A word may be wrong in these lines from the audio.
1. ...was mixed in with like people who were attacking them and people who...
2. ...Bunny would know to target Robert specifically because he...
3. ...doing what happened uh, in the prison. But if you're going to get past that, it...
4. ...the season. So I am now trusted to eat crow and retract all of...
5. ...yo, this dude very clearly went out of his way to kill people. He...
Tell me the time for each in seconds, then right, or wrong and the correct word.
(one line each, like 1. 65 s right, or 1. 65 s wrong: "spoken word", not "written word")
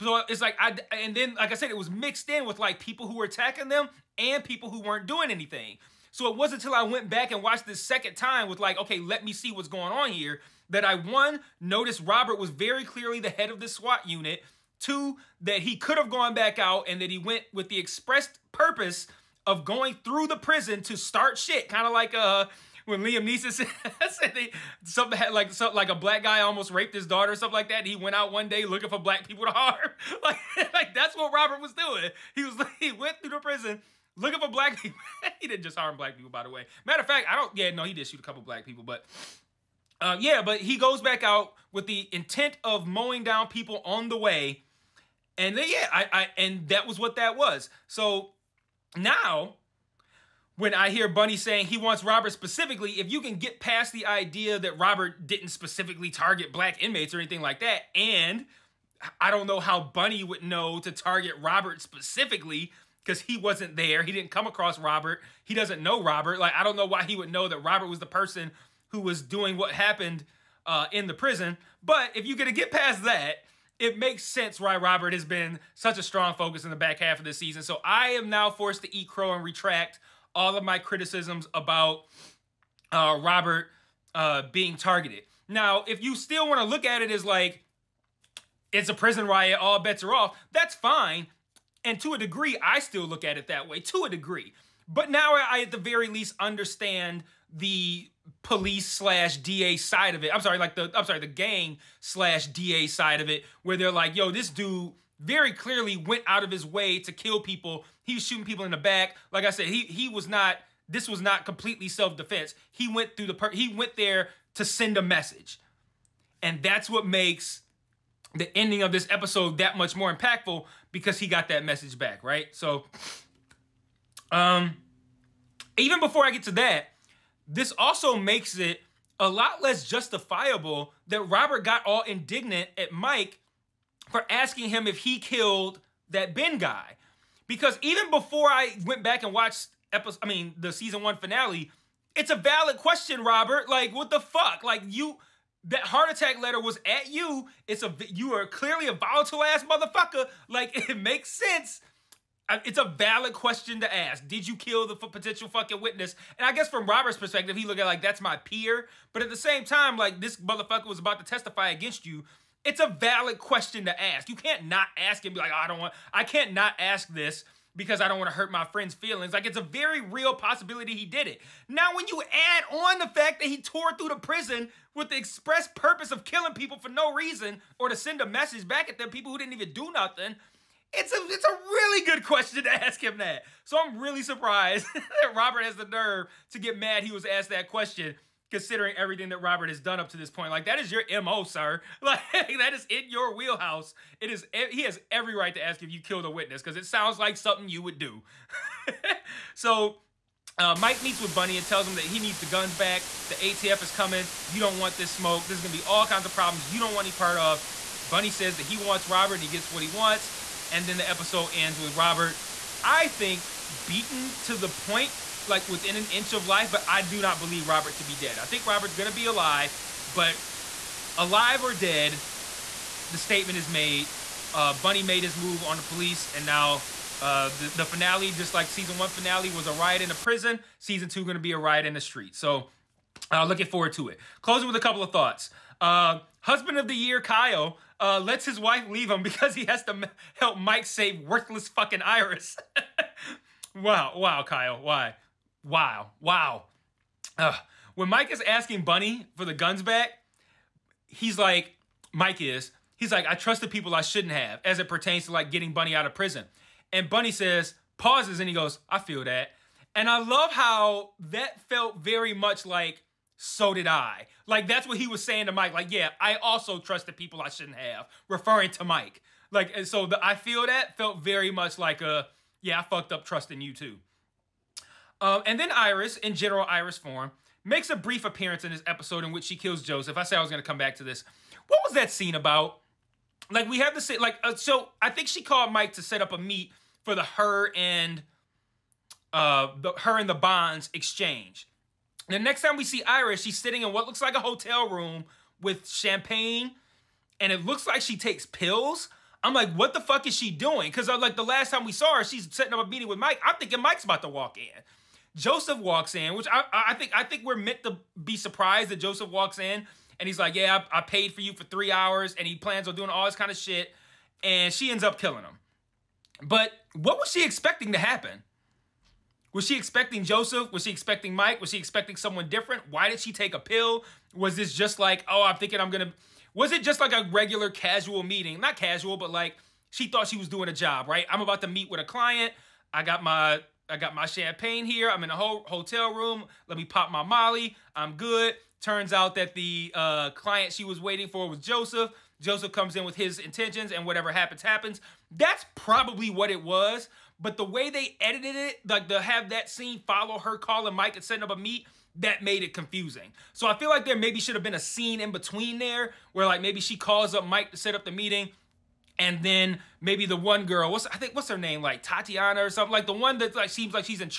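1. 1 s right
2. 59 s right
3. 69 s right
4. 77 s wrong: "forced", not "trusted"
5. 104 s right.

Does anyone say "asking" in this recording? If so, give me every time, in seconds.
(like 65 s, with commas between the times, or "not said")
134 s, 248 s.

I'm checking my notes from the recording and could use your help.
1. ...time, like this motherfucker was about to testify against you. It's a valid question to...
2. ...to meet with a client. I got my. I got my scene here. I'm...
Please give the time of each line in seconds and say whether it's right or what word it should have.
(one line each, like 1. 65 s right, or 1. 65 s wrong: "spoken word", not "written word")
1. 159 s right
2. 331 s wrong: "champagne", not "scene".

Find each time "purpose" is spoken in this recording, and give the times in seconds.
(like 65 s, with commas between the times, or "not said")
18 s, 175 s.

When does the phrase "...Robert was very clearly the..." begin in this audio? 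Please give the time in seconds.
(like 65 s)
12 s.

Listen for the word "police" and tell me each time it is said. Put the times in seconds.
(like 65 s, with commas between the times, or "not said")
98 s, 225 s.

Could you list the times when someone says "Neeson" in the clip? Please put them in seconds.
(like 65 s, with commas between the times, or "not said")
23 s.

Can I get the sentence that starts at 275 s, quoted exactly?
Um, and then Iris, in general Iris form, makes a brief appearance in this episode in which she kills Joseph.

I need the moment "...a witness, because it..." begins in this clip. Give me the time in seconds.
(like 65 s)
196 s.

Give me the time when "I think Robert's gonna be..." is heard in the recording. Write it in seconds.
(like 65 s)
218 s.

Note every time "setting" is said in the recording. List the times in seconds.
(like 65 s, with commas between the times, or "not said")
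302 s, 351 s.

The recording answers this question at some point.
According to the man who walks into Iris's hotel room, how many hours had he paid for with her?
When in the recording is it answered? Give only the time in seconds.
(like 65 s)
311 s.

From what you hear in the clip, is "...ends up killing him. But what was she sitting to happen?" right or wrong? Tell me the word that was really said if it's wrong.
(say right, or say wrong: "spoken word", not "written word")
wrong: "expecting", not "sitting".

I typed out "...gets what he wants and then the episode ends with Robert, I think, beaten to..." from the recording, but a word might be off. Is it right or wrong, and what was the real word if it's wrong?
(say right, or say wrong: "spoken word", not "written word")
right.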